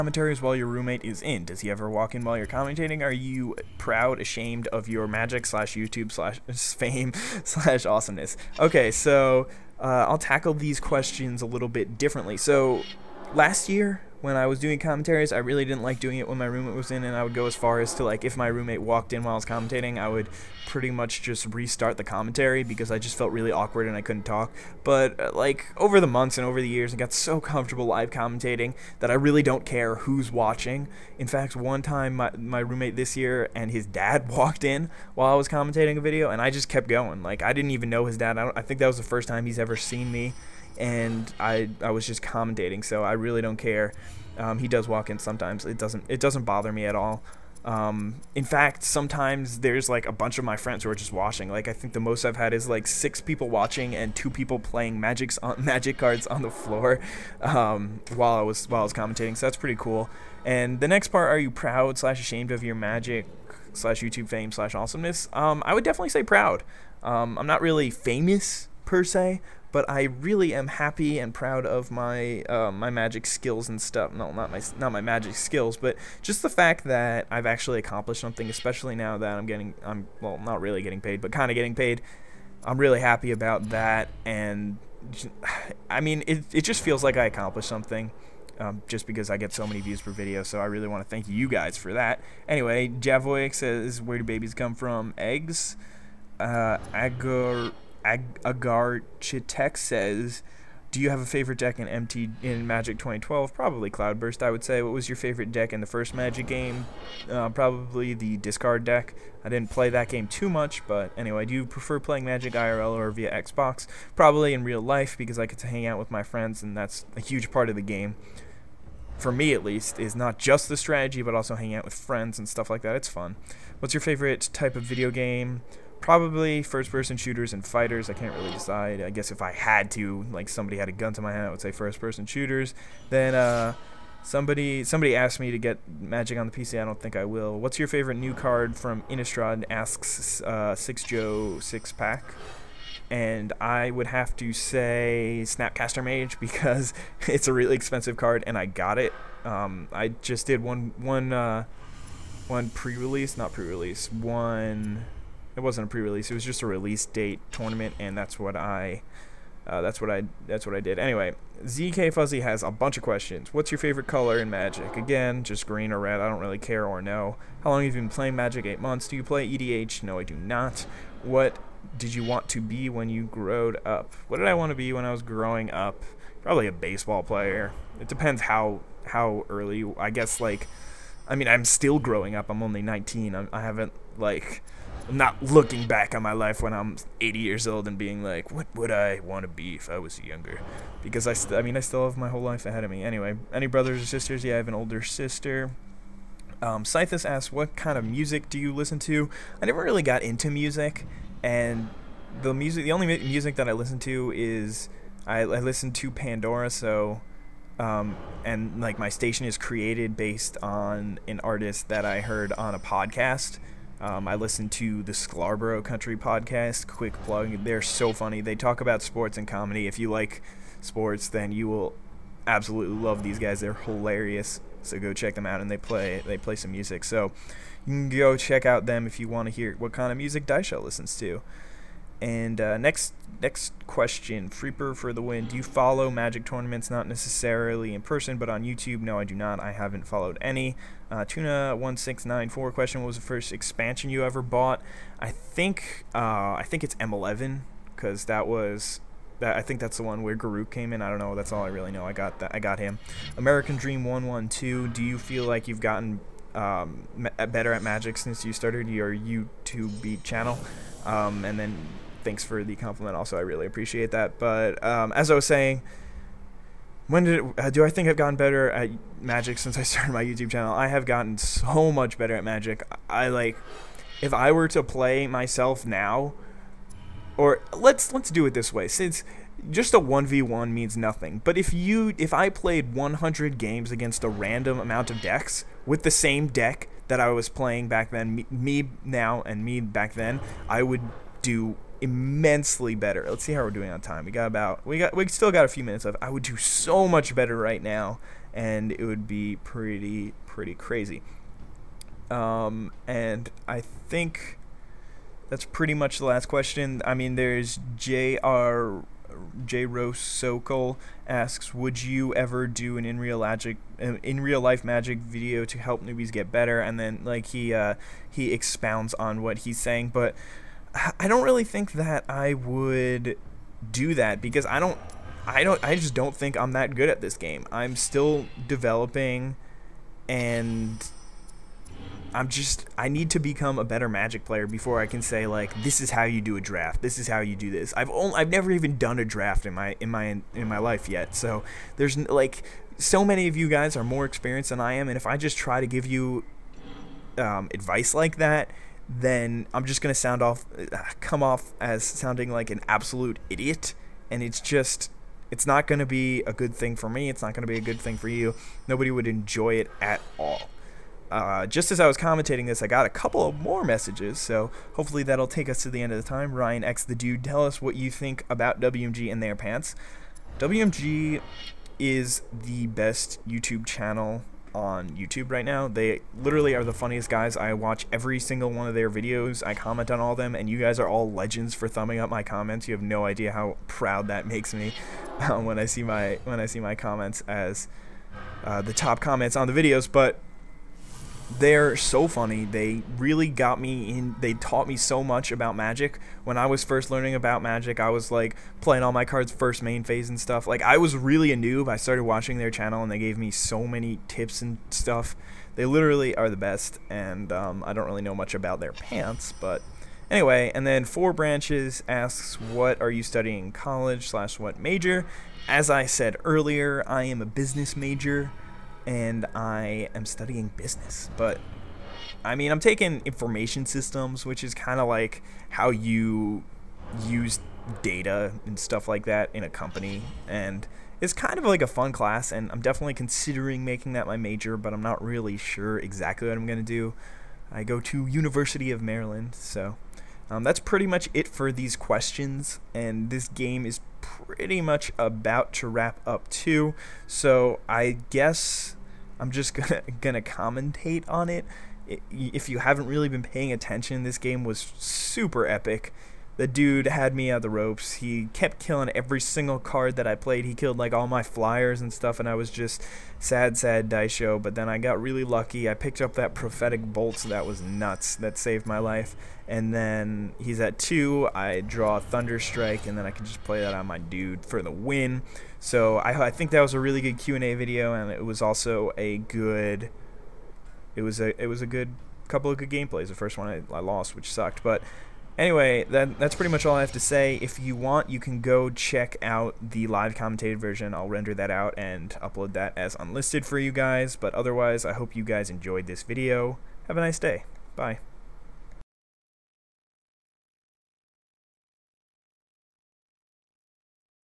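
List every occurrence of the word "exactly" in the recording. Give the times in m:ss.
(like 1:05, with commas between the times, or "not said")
7:15.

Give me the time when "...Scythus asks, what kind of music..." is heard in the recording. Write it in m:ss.
3:16.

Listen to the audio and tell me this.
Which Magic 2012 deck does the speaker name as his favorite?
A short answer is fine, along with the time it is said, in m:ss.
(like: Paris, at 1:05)
Cloudburst, at 1:43.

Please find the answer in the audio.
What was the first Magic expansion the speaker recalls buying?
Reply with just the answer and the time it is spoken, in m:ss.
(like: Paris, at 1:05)
M11, at 4:06.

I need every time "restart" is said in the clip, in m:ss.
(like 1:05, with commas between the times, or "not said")
0:21.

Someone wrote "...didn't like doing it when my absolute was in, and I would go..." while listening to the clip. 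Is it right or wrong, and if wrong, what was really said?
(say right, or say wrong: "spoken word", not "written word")
wrong: "roommate", not "absolute".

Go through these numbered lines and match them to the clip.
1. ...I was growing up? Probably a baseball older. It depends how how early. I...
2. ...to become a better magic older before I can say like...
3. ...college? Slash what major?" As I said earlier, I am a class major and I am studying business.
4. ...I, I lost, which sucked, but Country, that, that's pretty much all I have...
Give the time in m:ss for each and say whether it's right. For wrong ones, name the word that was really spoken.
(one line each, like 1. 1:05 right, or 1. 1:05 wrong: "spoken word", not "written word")
1. 2:55 wrong: "player", not "older"
2. 5:33 wrong: "player", not "older"
3. 6:53 wrong: "business", not "class"
4. 8:03 wrong: "Anyway", not "Country".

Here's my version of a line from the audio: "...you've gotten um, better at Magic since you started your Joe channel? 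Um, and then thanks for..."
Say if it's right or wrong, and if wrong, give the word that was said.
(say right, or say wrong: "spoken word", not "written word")
wrong: "YouTube", not "Joe".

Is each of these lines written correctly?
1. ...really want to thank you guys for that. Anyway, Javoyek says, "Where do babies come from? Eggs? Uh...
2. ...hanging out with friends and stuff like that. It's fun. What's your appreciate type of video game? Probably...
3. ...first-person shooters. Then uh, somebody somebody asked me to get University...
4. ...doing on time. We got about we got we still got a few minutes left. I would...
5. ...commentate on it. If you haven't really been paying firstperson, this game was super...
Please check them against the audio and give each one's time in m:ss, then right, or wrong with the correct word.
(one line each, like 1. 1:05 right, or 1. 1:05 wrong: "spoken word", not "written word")
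1. 1:30 right
2. 2:01 wrong: "favorite", not "appreciate"
3. 2:11 wrong: "Magic", not "University"
4. 4:53 right
5. 7:30 wrong: "attention", not "firstperson".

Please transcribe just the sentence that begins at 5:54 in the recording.
And it's just, it's not going to be a good thing for me.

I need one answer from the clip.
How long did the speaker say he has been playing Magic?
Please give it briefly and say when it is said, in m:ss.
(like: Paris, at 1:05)
8 months, at 2:48.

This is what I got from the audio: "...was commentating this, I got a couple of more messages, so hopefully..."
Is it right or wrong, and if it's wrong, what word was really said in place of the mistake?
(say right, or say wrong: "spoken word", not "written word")
right.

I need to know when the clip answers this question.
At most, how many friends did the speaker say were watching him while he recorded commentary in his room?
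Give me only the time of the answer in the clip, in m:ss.
0:52.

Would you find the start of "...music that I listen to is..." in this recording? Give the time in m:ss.
3:23.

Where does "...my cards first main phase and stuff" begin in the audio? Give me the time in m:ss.
6:39.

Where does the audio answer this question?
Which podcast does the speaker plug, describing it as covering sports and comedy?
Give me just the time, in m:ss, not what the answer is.
3:35.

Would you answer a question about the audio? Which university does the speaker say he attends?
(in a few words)
University of Maryland.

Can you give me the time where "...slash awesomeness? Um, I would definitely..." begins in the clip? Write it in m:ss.
1:04.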